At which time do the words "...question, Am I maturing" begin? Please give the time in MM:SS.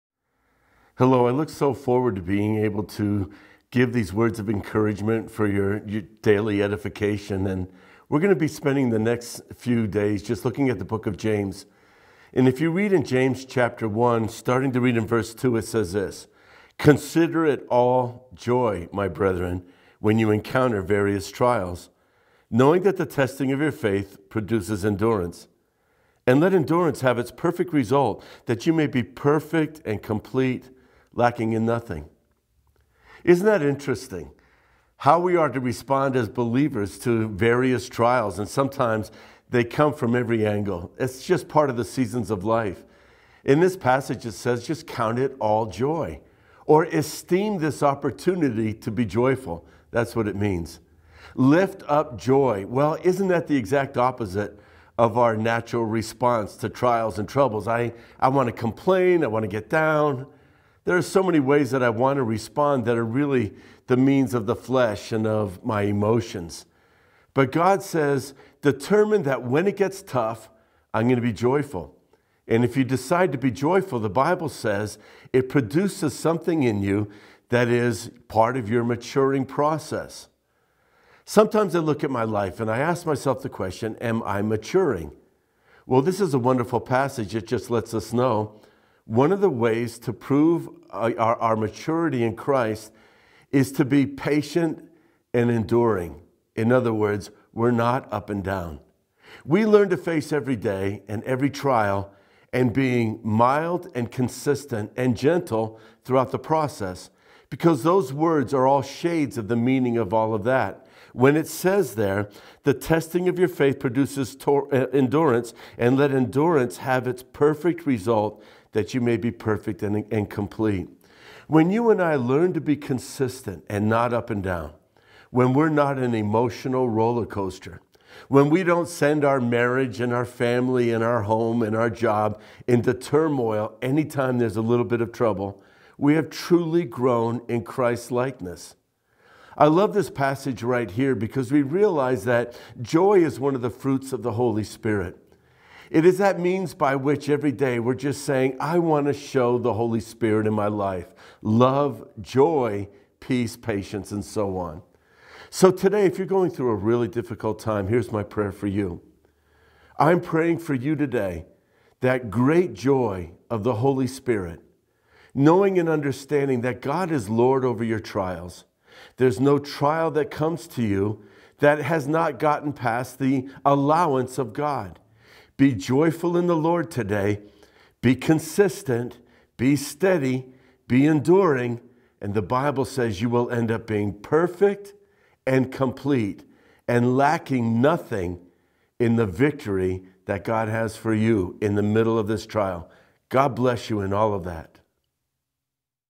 01:23.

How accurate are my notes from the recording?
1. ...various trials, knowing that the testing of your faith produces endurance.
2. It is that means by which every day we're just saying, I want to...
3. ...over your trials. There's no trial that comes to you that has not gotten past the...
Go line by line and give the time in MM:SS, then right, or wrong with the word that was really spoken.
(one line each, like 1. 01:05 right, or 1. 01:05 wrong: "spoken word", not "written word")
1. 00:20 right
2. 02:25 right
3. 02:47 right.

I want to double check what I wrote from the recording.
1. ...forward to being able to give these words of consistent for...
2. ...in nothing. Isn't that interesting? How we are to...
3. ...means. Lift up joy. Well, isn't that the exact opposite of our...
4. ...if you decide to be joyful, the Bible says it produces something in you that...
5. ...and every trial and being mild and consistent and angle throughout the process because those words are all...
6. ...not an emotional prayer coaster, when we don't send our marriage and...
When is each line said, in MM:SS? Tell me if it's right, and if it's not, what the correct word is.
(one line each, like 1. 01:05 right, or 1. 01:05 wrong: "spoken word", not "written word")
1. 00:01 wrong: "encouragement", not "consistent"
2. 00:31 right
3. 00:50 right
4. 01:12 right
5. 01:41 wrong: "gentle", not "angle"
6. 02:05 wrong: "roller", not "prayer".